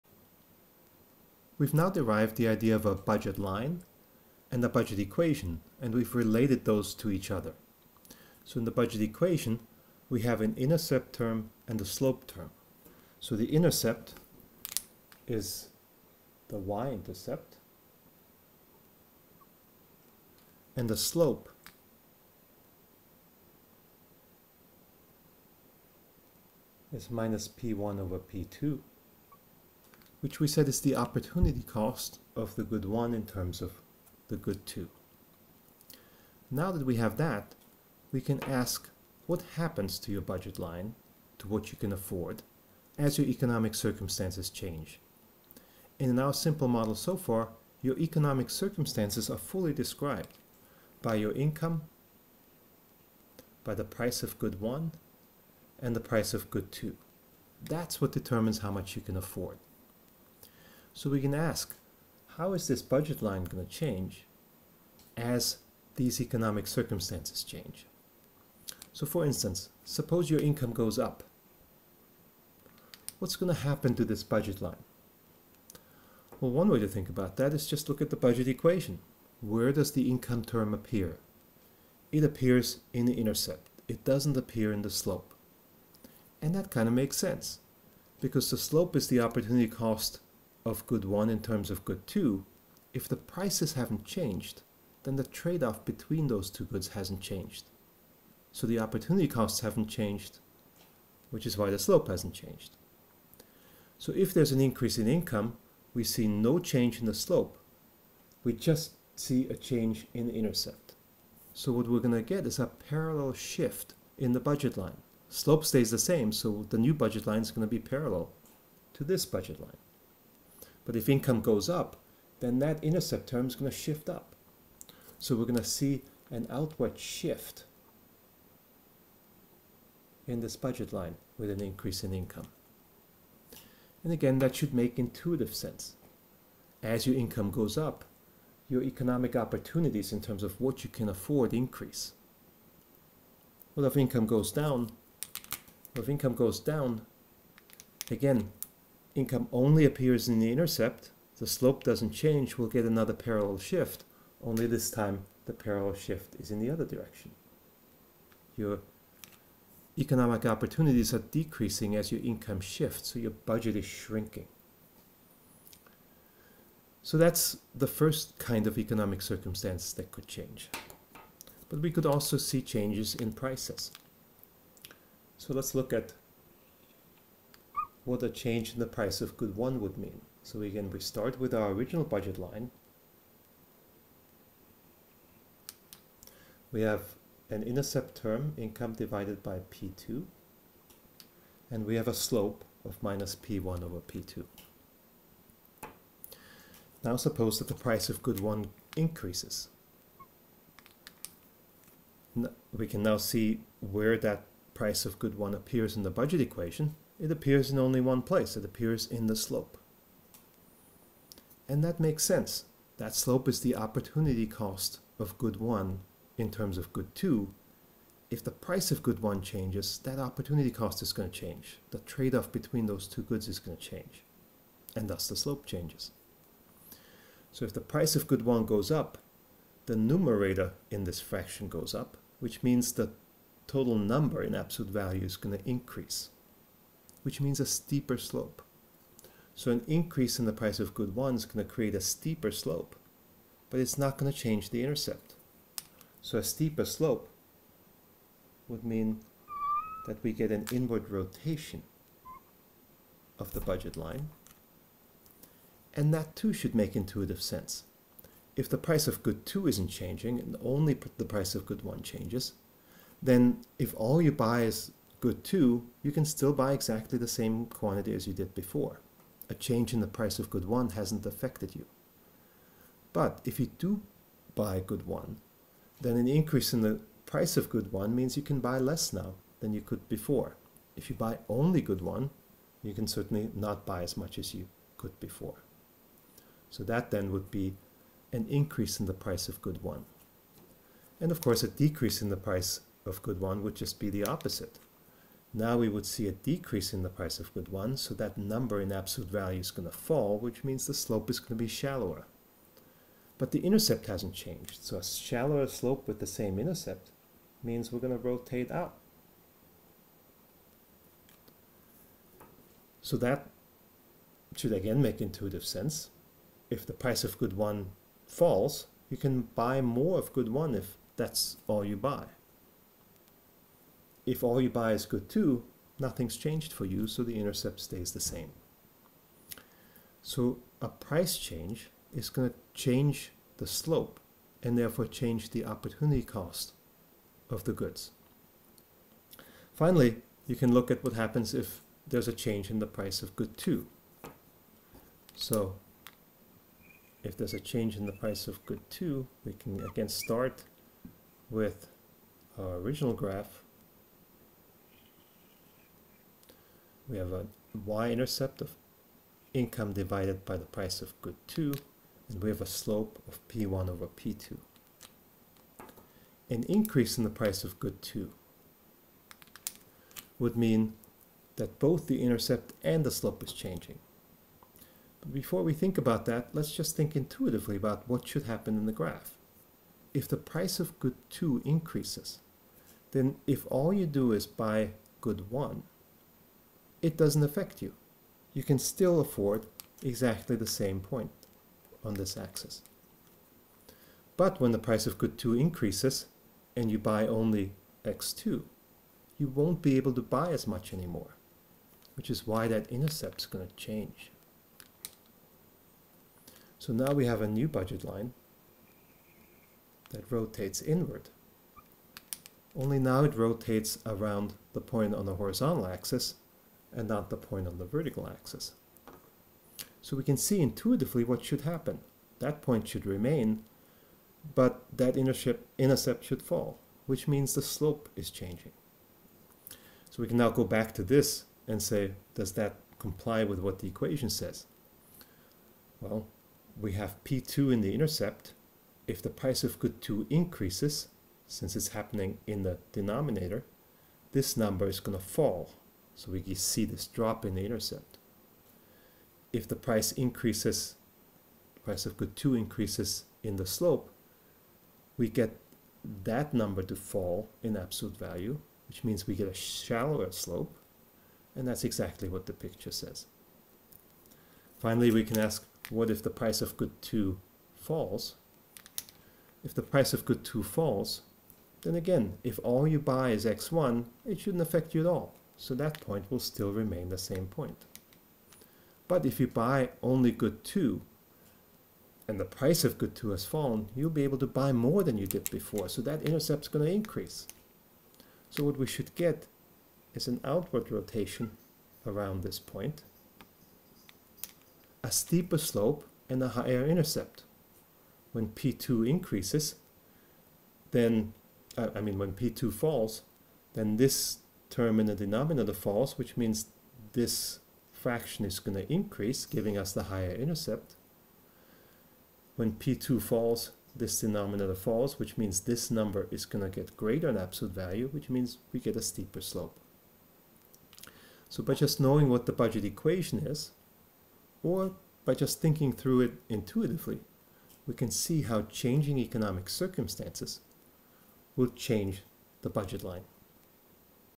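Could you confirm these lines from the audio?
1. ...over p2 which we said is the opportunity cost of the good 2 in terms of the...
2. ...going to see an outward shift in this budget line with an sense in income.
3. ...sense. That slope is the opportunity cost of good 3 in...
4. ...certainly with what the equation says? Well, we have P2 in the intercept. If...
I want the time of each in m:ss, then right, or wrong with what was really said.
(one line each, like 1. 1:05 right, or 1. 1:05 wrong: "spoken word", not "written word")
1. 0:27 wrong: "1", not "2"
2. 2:05 wrong: "increase", not "sense"
3. 3:32 wrong: "1", not "3"
4. 7:12 wrong: "comply", not "certainly".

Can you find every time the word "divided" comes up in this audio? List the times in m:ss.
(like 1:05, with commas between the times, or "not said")
3:08, 5:59.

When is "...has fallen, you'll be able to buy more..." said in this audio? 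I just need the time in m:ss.
8:03.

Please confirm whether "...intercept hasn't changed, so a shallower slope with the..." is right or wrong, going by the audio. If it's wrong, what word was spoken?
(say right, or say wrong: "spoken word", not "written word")
right.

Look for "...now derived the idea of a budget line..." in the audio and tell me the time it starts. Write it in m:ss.
0:01.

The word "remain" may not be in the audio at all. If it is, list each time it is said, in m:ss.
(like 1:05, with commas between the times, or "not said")
7:03, 7:56.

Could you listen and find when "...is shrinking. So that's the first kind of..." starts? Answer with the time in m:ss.
2:43.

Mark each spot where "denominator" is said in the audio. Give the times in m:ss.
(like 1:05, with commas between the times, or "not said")
7:22, 8:25, 8:34.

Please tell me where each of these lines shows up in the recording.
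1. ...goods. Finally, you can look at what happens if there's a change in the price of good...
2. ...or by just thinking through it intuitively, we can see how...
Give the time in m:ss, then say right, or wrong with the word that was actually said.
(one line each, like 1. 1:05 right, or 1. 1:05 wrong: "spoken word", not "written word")
1. 5:37 right
2. 8:44 right.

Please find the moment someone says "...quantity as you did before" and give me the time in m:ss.
4:27.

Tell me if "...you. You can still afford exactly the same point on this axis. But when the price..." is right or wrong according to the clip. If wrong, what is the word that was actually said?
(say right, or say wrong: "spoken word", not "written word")
right.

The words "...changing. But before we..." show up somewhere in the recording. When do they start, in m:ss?
6:13.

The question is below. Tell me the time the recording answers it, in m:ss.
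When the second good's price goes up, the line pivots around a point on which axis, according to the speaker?
6:55.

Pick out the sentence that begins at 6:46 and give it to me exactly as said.
So now we have a new budget line that rotates inward.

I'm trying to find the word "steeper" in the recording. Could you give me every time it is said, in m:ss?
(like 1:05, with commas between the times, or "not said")
3:57, 4:02, 4:06, 8:15, 8:39.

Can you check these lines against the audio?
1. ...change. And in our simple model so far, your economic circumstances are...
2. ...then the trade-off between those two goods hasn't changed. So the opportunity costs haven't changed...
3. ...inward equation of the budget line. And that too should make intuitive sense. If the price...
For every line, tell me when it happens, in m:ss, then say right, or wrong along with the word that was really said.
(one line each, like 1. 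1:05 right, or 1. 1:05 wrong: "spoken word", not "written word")
1. 0:44 right
2. 1:35 right
3. 4:10 wrong: "rotation", not "equation".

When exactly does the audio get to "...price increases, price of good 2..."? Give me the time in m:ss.
7:29.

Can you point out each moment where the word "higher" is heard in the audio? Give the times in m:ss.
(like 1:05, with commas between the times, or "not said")
8:16, 8:30.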